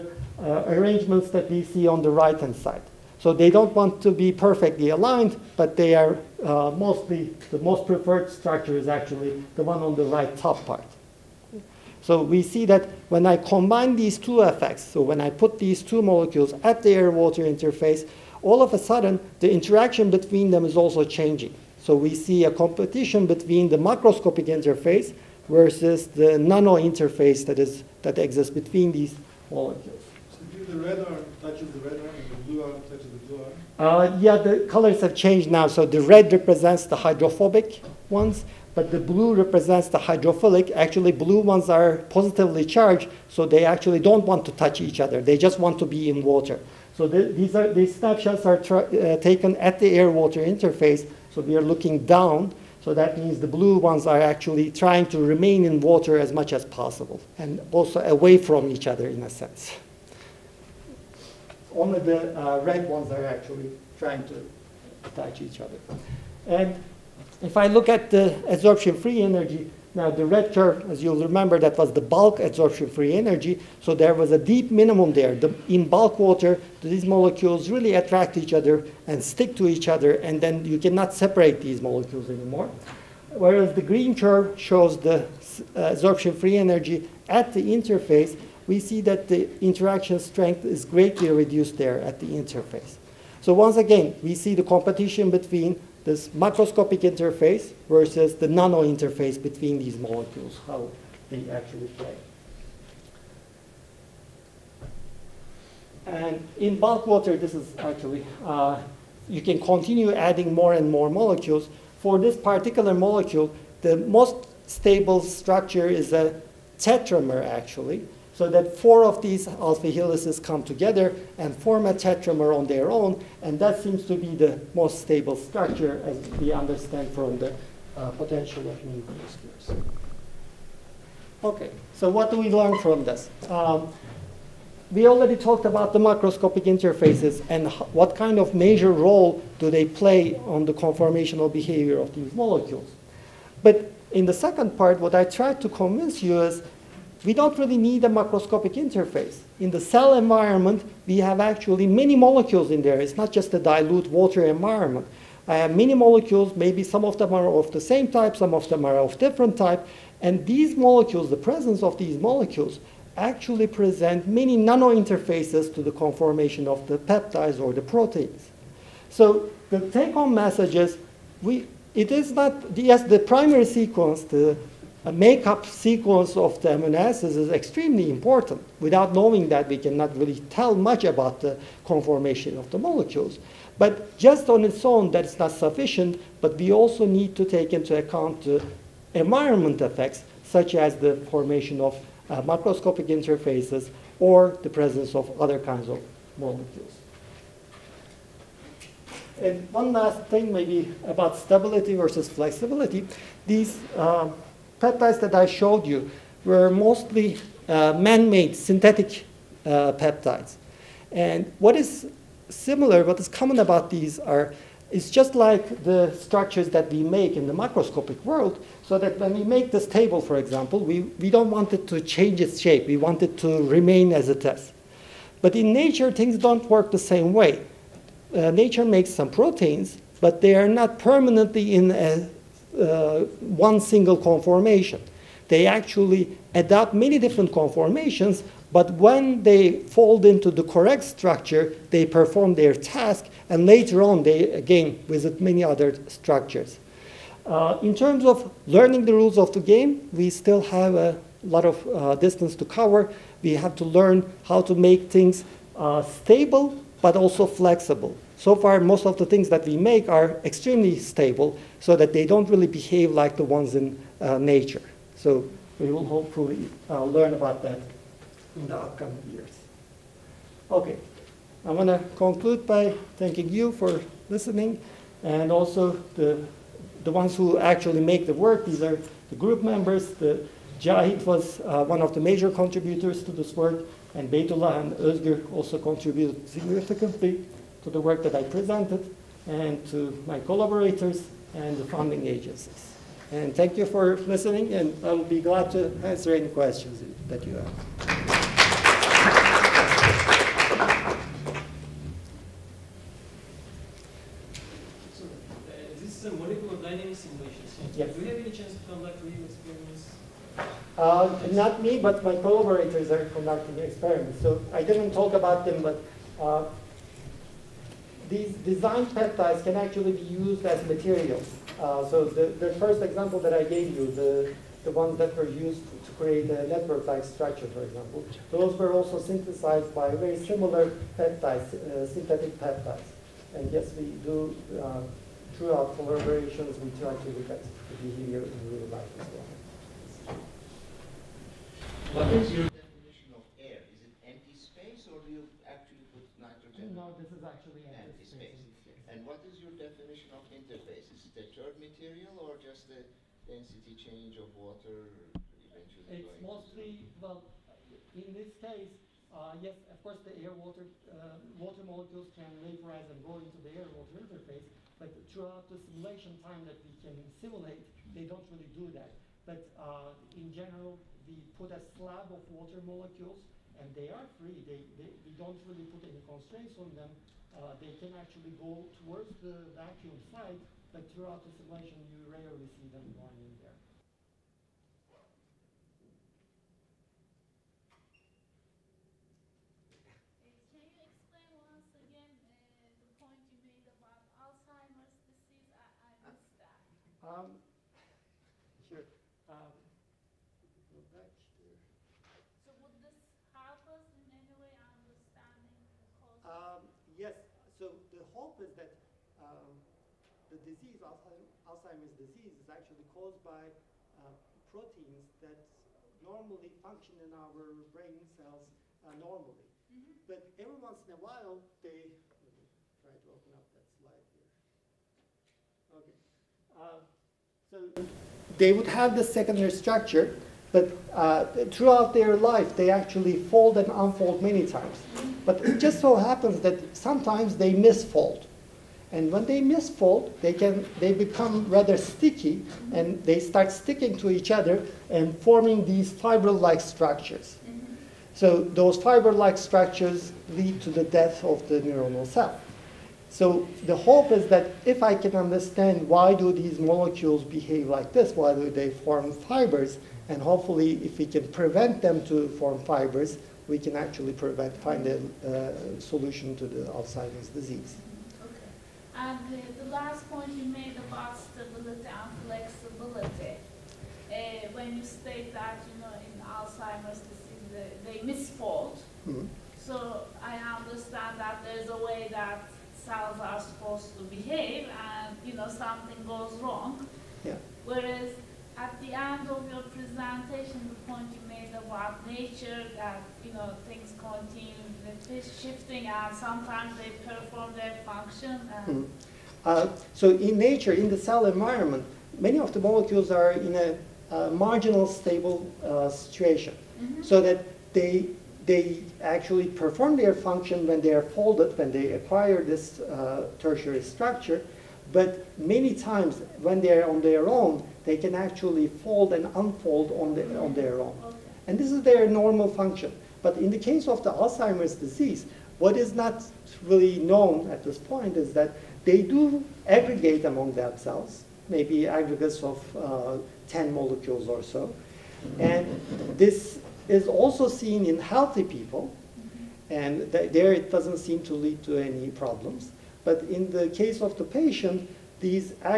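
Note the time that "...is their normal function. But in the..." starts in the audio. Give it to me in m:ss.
8:41.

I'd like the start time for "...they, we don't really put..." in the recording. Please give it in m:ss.
6:14.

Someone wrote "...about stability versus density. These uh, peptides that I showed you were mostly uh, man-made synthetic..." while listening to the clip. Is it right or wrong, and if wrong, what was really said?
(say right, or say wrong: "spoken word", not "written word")
wrong: "flexibility", not "density".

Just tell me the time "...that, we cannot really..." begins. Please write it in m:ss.
2:59.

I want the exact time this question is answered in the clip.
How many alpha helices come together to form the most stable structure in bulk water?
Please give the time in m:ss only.
1:58.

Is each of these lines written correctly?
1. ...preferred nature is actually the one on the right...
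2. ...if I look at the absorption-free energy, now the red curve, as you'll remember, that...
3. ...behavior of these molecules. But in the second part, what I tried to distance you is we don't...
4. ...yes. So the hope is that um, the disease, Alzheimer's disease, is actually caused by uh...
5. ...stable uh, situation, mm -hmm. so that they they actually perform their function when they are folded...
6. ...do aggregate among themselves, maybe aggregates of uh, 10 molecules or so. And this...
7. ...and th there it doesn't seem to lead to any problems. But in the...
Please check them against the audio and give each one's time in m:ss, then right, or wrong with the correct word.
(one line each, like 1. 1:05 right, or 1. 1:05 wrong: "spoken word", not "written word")
1. 0:07 wrong: "structure", not "nature"
2. 1:07 right
3. 2:21 wrong: "convince", not "distance"
4. 6:47 right
5. 8:25 right
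6. 8:49 right
7. 8:59 right.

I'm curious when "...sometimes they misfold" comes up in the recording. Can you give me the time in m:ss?
7:16.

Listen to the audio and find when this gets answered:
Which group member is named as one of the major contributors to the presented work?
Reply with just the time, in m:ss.
4:40.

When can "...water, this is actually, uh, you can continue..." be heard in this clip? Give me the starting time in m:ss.
1:47.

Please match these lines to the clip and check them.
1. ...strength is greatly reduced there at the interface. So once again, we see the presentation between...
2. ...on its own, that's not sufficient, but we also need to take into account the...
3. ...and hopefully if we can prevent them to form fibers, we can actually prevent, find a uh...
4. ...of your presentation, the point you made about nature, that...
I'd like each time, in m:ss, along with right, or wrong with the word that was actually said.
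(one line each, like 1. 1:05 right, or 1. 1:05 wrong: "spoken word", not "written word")
1. 1:30 wrong: "competition", not "presentation"
2. 3:04 right
3. 7:40 right
4. 8:09 right.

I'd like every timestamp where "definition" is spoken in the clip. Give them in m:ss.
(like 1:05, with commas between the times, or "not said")
5:42, 5:49.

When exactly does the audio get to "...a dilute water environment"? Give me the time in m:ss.
2:33.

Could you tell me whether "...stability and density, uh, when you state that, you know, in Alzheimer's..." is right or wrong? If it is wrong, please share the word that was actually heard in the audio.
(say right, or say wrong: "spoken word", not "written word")
wrong: "flexibility", not "density".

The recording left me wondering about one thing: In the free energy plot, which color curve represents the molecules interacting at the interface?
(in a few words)
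Green.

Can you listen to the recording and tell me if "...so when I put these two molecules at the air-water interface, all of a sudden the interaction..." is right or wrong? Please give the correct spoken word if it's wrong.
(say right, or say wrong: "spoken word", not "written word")
right.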